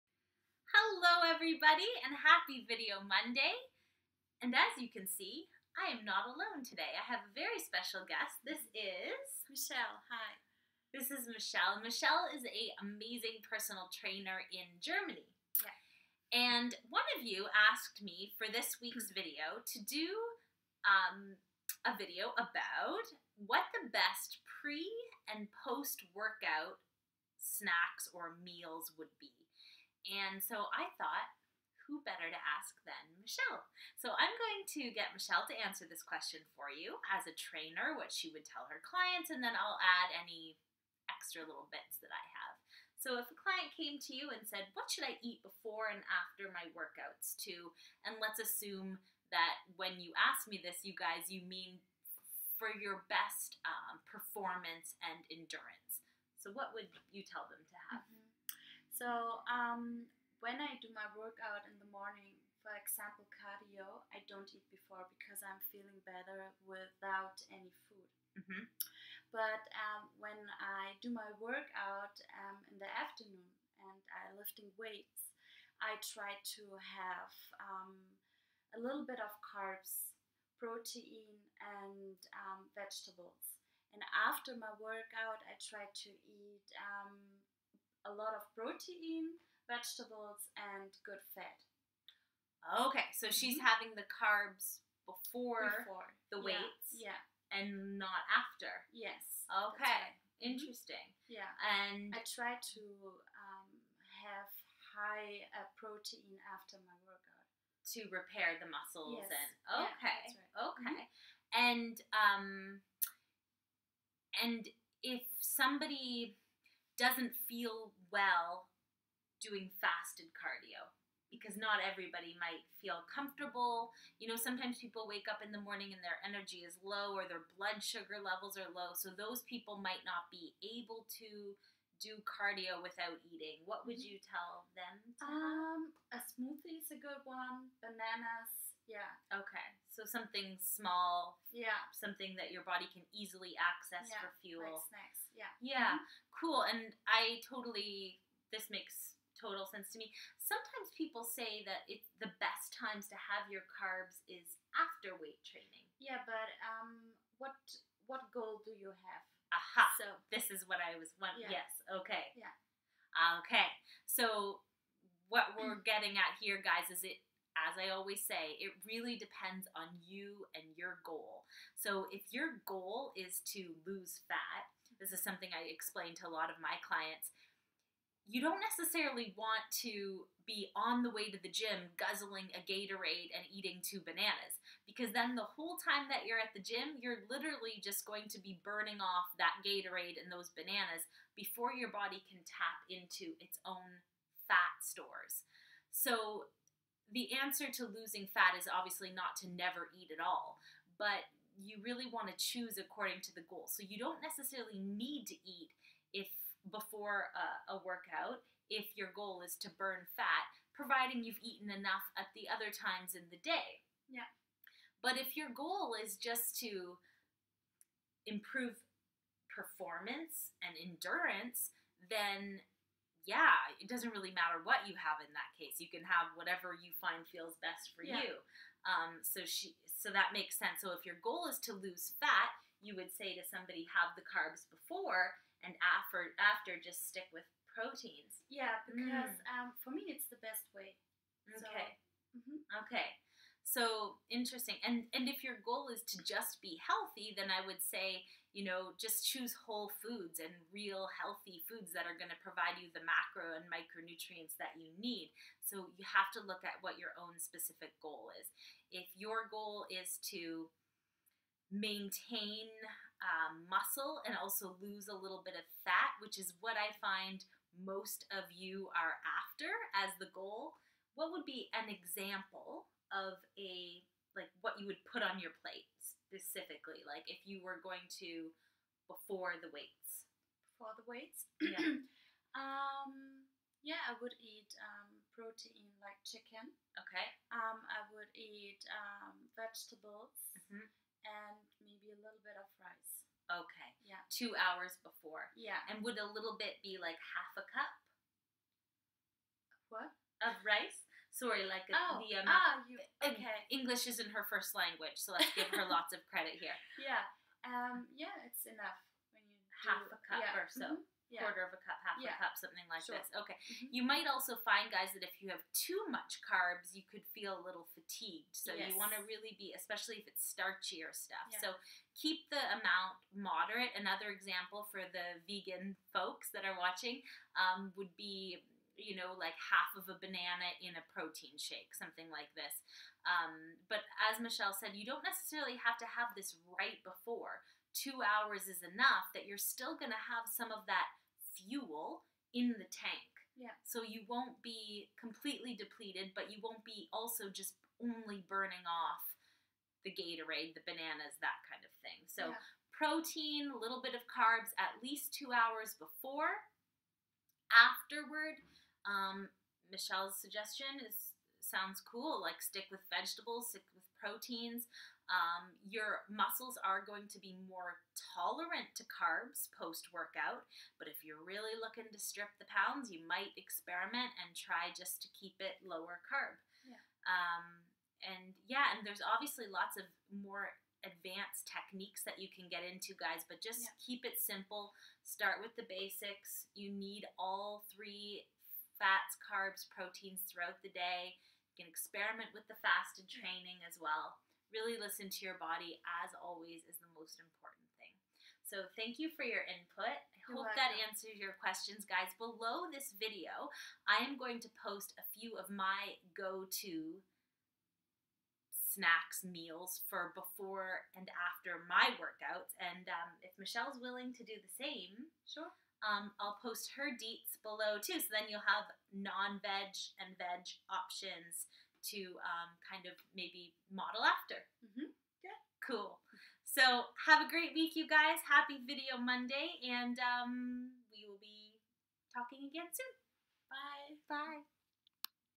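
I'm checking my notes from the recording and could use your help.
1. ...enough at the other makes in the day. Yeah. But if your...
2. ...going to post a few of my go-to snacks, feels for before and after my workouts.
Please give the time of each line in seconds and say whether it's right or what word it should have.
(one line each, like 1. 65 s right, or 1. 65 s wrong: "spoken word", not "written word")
1. 211 s wrong: "times", not "makes"
2. 404 s wrong: "meals", not "feels".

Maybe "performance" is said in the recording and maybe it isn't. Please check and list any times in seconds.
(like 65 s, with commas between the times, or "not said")
54 s, 219 s.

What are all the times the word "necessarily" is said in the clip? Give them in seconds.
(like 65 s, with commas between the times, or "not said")
178 s, 204 s, 335 s.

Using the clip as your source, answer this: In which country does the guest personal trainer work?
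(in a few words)
Germany.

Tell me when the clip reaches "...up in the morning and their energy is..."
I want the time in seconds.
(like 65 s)
125 s.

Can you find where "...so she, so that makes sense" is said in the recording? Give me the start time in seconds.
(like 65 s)
229 s.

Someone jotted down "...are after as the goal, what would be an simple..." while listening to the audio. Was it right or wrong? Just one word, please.
wrong.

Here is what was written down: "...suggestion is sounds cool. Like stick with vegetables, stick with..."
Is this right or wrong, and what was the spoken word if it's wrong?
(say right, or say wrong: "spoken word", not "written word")
right.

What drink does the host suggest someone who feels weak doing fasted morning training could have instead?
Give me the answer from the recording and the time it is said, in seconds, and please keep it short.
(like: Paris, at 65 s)
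A smoothie, at 136 s.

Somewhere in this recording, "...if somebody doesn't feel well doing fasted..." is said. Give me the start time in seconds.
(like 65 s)
115 s.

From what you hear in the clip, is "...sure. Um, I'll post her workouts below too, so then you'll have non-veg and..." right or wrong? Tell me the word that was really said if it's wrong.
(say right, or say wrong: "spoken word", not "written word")
wrong: "deets", not "workouts".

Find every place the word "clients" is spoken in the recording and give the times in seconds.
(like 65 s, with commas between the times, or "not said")
38 s, 43 s, 176 s.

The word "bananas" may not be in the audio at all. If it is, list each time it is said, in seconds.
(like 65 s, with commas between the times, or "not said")
137 s, 184 s, 190 s, 330 s, 350 s.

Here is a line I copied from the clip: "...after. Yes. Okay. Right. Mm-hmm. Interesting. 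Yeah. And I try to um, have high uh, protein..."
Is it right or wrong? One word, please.
right.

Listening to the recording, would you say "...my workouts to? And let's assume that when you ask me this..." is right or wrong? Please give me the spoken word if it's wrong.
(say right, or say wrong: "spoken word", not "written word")
right.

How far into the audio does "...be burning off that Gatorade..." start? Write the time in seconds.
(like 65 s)
188 s.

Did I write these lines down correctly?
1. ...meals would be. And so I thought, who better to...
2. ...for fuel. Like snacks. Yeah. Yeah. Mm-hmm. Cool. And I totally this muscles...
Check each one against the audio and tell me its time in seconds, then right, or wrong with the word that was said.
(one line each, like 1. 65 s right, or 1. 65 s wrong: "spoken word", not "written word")
1. 28 s right
2. 144 s wrong: "makes", not "muscles".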